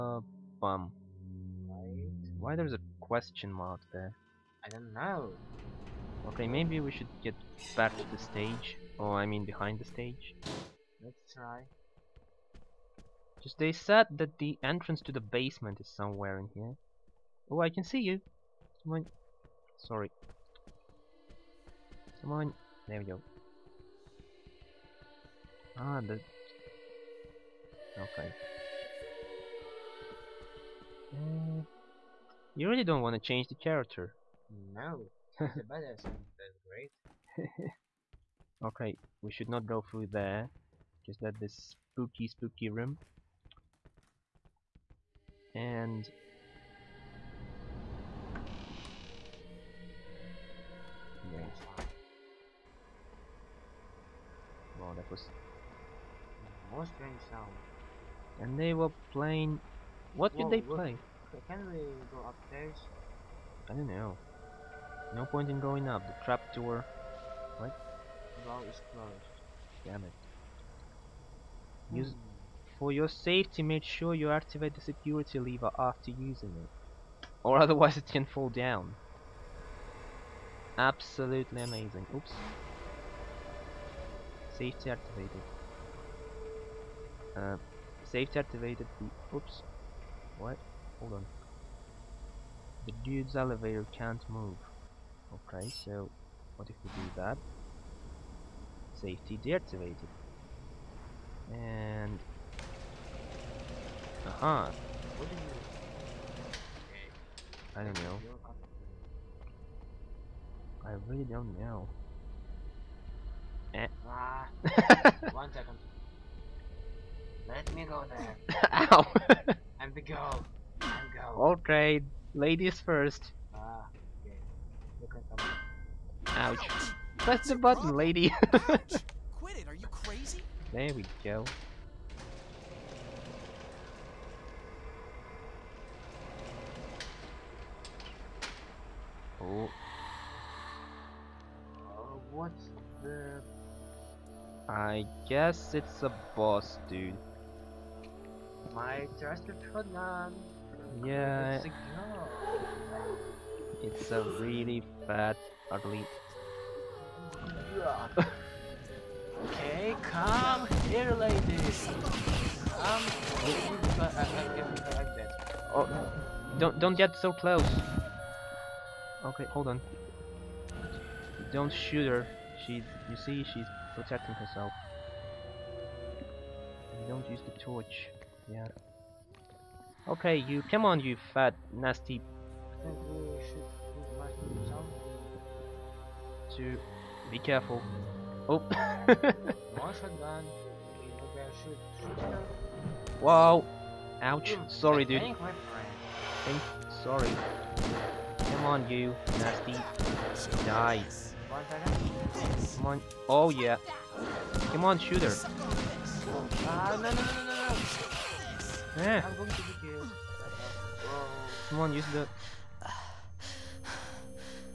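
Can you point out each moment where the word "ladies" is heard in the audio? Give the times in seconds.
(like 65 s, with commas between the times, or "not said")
122 s, 161 s.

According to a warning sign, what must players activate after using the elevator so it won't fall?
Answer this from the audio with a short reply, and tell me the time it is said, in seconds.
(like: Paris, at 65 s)
The security lever, at 74 s.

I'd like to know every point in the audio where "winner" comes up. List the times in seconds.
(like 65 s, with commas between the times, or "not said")
not said.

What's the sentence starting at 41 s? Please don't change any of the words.
Just that this spooky, spooky room.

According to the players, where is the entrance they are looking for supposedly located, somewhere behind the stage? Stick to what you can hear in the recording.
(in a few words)
The basement.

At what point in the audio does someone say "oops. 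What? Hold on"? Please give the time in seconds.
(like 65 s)
89 s.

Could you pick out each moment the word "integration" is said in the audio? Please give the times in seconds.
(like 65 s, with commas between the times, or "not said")
not said.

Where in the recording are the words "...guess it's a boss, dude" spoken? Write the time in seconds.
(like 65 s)
145 s.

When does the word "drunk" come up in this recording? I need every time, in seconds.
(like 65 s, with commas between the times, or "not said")
not said.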